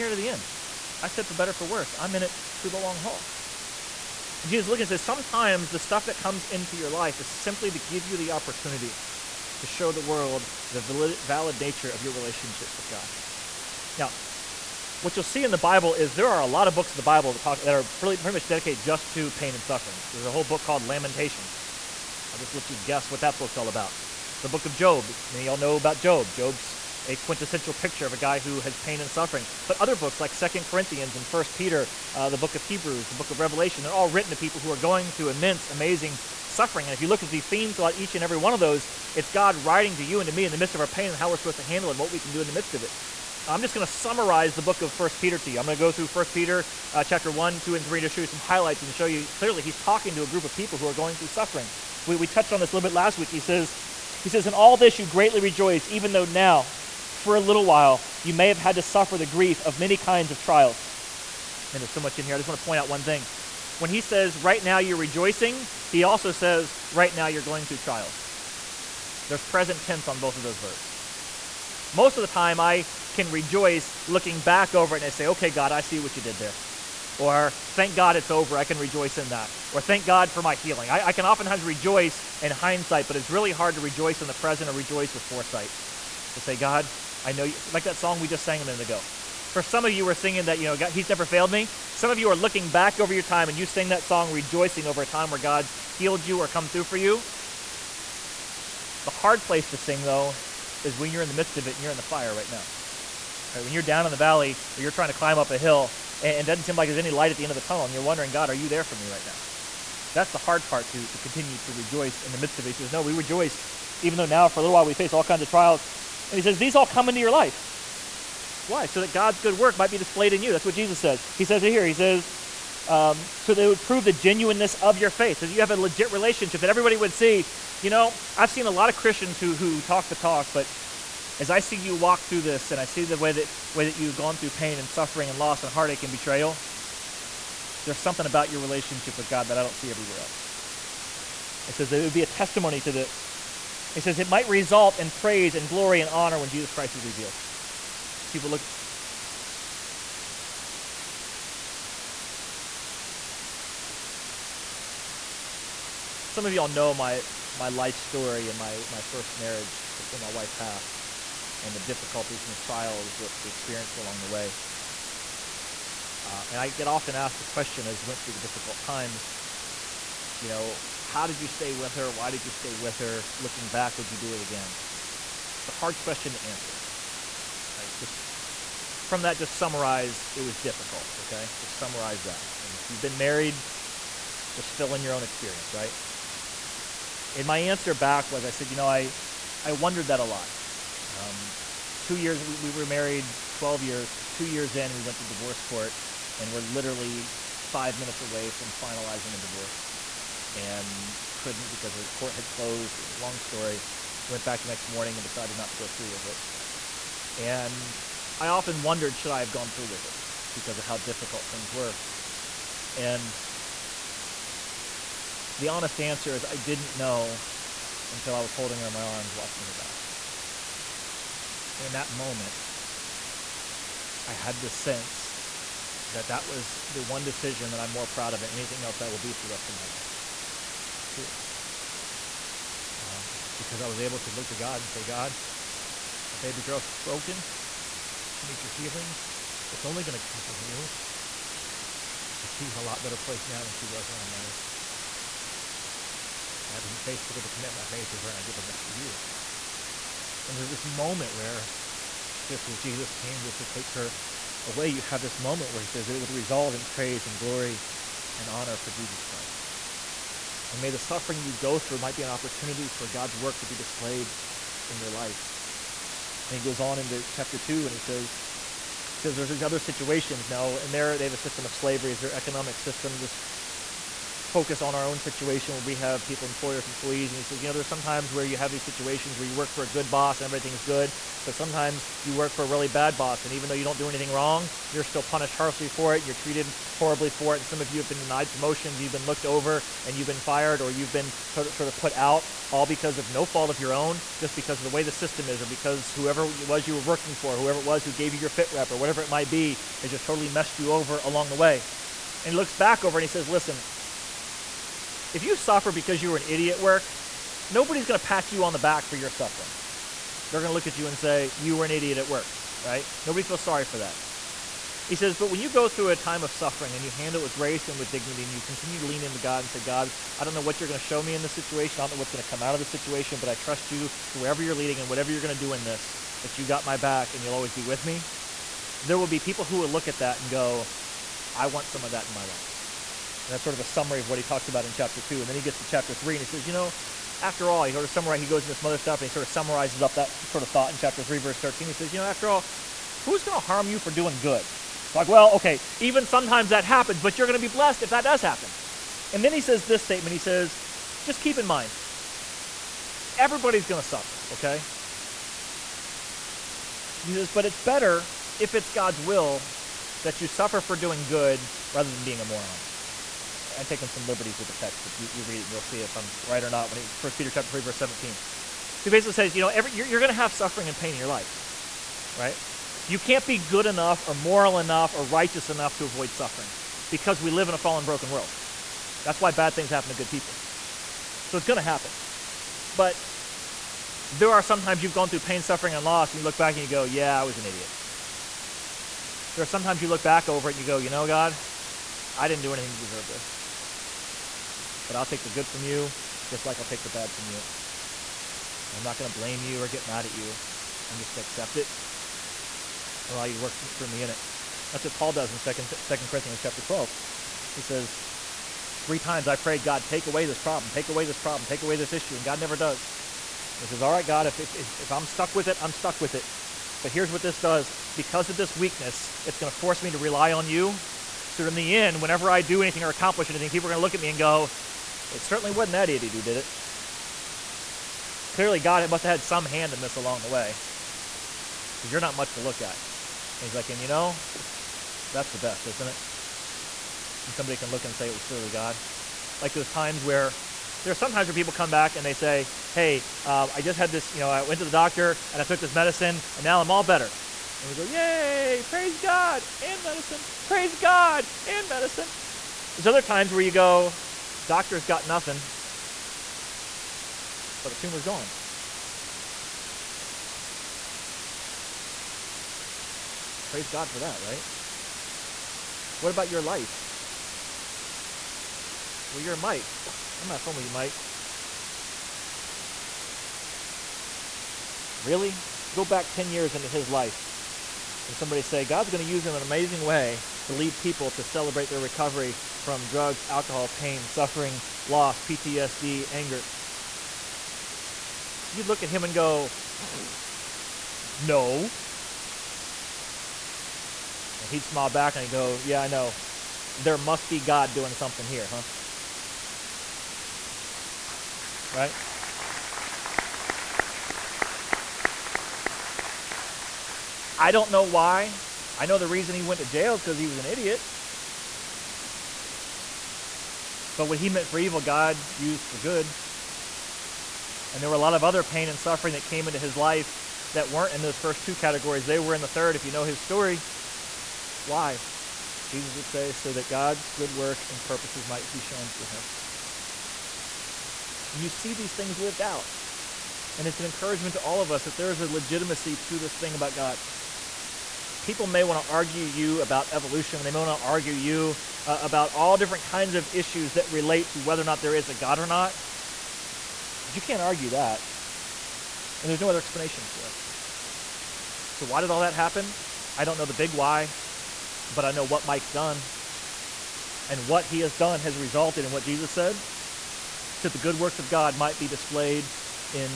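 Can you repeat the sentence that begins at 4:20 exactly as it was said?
And may the suffering you go through might be an opportunity for God's work to be displayed in your life.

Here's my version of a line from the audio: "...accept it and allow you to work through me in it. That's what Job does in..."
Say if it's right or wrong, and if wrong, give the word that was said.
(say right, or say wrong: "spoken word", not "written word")
wrong: "Paul", not "Job".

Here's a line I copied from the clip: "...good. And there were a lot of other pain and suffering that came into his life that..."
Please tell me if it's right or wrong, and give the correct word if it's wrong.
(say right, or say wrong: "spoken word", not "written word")
right.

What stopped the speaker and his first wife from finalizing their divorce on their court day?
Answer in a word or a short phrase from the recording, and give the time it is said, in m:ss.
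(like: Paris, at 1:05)
The court had closed, at 3:21.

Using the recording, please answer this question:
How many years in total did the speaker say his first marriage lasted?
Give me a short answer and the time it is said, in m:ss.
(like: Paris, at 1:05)
12, at 3:13.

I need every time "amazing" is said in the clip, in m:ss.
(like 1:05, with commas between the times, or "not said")
0:35, 7:59.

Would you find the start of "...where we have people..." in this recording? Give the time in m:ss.
4:35.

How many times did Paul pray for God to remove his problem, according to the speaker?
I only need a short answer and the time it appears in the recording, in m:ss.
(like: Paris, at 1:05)
3, at 6:49.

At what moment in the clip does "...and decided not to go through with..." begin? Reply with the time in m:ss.
3:25.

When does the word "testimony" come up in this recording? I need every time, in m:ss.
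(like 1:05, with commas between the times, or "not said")
2:22.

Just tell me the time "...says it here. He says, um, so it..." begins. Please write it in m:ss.
2:01.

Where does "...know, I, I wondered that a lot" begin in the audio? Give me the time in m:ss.
3:08.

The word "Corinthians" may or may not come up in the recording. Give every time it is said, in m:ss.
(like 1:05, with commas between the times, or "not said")
0:30, 6:46.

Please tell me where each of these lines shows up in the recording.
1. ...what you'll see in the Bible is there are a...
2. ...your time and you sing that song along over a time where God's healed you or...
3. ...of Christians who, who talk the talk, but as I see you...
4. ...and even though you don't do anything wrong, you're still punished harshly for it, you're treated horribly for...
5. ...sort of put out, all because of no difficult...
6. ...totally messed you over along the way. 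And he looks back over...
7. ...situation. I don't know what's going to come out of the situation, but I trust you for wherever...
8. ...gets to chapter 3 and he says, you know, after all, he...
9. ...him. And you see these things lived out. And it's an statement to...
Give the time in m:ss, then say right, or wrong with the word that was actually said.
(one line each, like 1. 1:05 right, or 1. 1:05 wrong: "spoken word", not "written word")
1. 0:15 right
2. 1:33 wrong: "rejoicing", not "along"
3. 2:08 right
4. 4:43 right
5. 4:51 wrong: "fault", not "difficult"
6. 5:00 right
7. 5:21 right
8. 5:35 right
9. 8:49 wrong: "encouragement", not "statement".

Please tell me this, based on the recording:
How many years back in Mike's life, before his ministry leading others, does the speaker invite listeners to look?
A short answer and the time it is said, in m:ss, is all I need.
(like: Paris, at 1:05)
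10, at 7:56.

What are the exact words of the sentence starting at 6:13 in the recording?
You can't be good enough or moral enough or righteous enough to avoid suffering because we live in a fallen, broken world.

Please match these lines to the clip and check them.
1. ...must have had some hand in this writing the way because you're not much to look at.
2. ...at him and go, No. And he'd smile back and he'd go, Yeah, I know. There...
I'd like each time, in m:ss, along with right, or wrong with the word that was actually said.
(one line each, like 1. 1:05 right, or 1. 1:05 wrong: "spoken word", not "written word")
1. 7:09 wrong: "along", not "writing"
2. 8:09 right.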